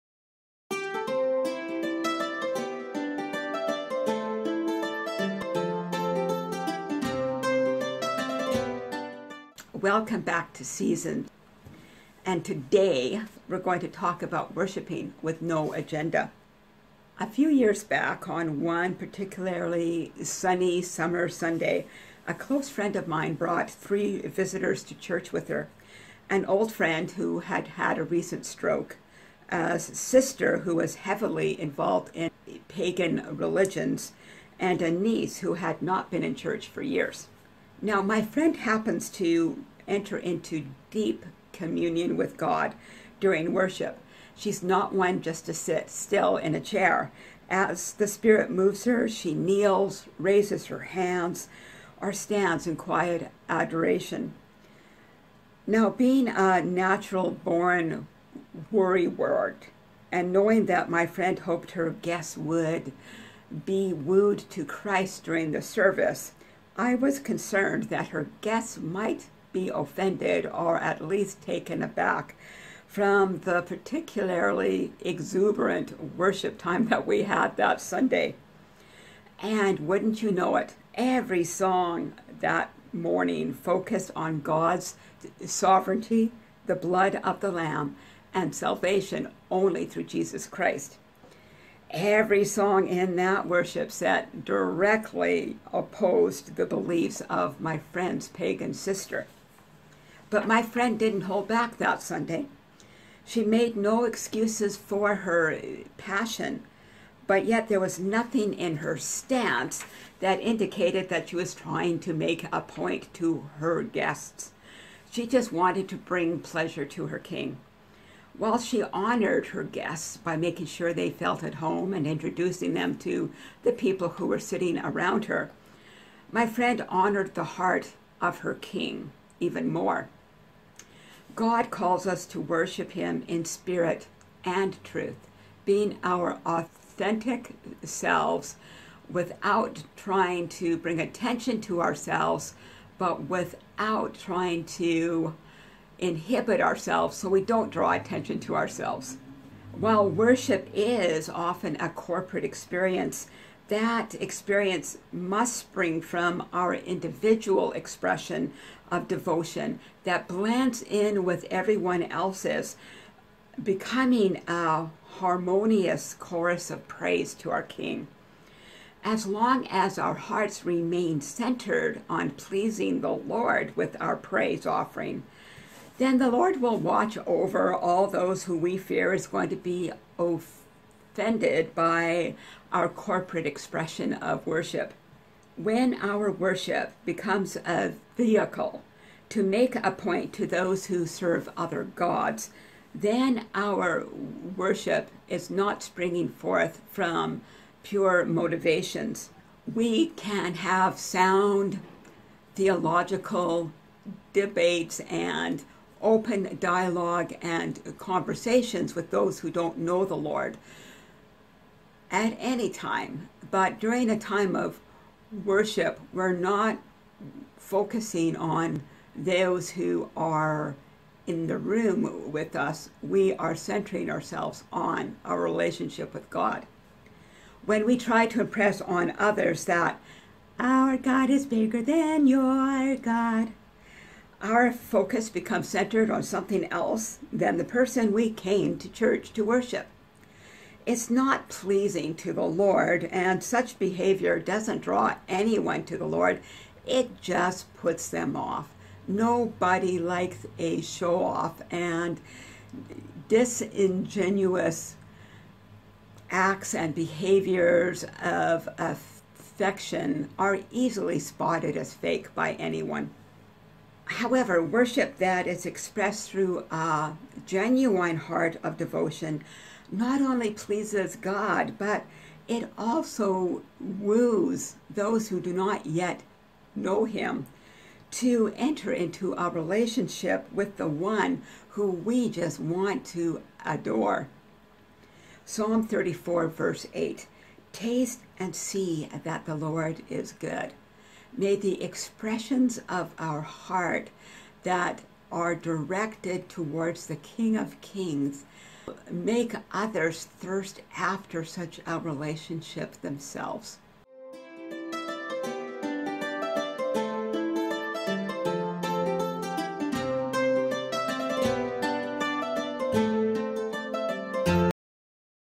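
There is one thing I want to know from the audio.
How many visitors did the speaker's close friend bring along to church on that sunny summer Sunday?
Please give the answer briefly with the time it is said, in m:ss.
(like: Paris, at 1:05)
3, at 0:23.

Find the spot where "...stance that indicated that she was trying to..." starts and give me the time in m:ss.
1:48.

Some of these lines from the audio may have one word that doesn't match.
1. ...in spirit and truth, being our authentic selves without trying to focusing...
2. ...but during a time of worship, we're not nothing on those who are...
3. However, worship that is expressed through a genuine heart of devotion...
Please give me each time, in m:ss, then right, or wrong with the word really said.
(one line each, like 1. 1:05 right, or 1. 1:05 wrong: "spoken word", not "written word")
1. 2:13 wrong: "bring", not "focusing"
2. 3:33 wrong: "focusing", not "nothing"
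3. 4:24 right.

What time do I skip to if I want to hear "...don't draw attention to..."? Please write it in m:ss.
2:27.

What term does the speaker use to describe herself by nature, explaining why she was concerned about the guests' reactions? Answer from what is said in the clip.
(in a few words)
Worrywart.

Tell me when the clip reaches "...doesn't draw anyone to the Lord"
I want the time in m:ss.
4:04.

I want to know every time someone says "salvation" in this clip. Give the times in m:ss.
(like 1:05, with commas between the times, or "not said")
1:28.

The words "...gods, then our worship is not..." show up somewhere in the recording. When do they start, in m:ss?
3:11.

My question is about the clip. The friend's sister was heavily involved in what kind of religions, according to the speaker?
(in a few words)
Pagan religions.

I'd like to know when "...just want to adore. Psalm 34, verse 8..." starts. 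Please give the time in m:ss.
4:42.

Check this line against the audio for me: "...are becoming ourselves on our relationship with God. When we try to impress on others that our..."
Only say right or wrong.
wrong.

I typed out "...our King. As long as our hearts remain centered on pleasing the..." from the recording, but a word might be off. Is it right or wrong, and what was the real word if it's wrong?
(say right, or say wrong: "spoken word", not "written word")
right.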